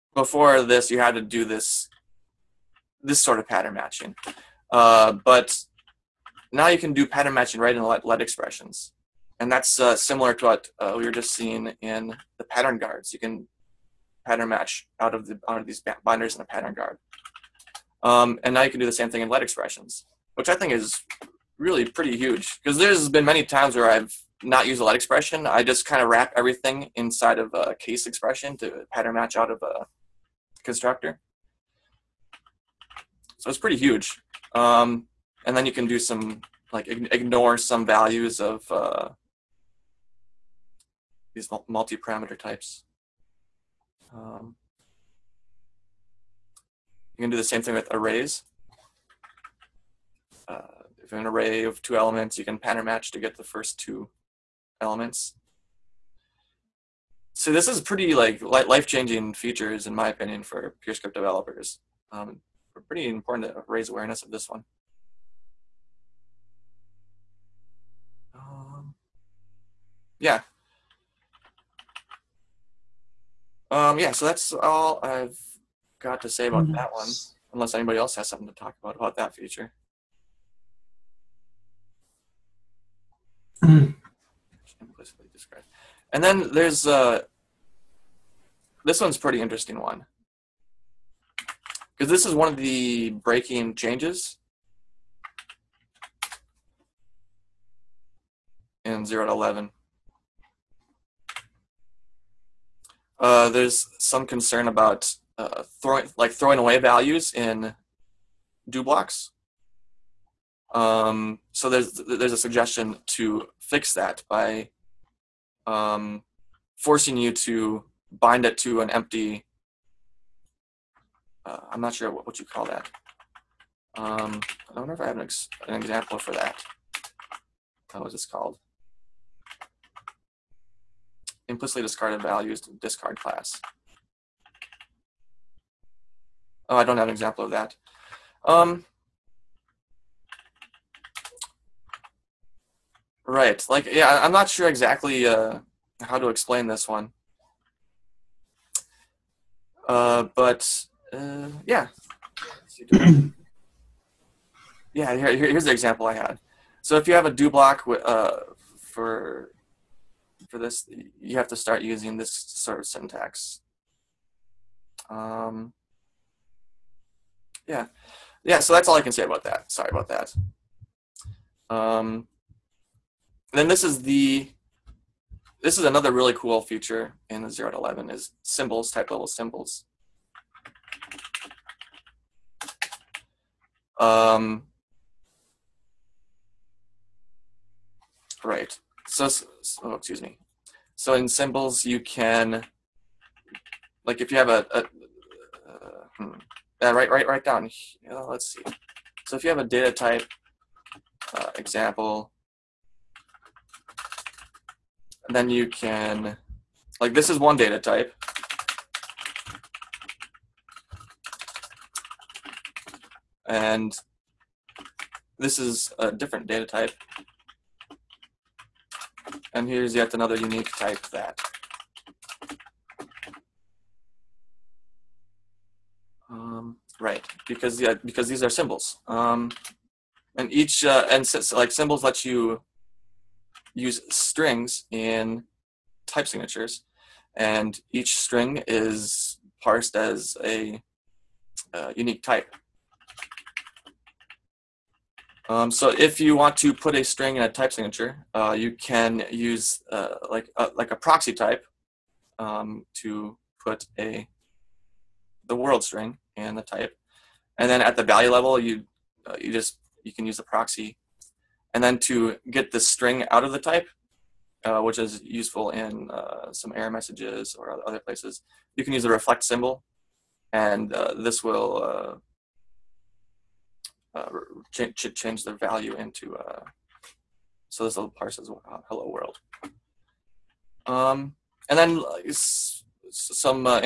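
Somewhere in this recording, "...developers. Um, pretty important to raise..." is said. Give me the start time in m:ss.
1:01.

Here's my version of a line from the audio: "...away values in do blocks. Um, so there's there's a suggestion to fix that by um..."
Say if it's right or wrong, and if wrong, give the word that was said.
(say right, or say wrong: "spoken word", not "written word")
right.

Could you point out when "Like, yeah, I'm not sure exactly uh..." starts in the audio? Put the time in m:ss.
2:23.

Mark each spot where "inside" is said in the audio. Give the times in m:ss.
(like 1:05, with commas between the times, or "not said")
0:26.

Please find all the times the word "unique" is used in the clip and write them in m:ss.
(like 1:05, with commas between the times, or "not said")
3:40, 4:01.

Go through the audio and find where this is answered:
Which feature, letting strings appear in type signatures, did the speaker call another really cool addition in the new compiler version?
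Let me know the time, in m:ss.
2:58.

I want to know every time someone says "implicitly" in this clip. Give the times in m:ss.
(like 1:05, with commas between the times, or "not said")
1:23, 2:11.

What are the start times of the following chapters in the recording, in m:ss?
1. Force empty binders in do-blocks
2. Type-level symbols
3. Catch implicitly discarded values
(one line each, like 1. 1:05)
1. 1:17
2. 2:49
3. 1:29.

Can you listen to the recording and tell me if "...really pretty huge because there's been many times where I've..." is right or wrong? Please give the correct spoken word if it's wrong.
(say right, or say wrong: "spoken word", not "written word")
right.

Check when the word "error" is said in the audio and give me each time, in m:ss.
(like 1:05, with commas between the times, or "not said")
4:26.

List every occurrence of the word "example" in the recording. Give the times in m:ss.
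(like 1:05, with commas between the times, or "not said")
2:05, 2:17, 2:35, 3:21.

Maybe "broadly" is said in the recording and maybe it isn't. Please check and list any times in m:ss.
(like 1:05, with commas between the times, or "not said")
not said.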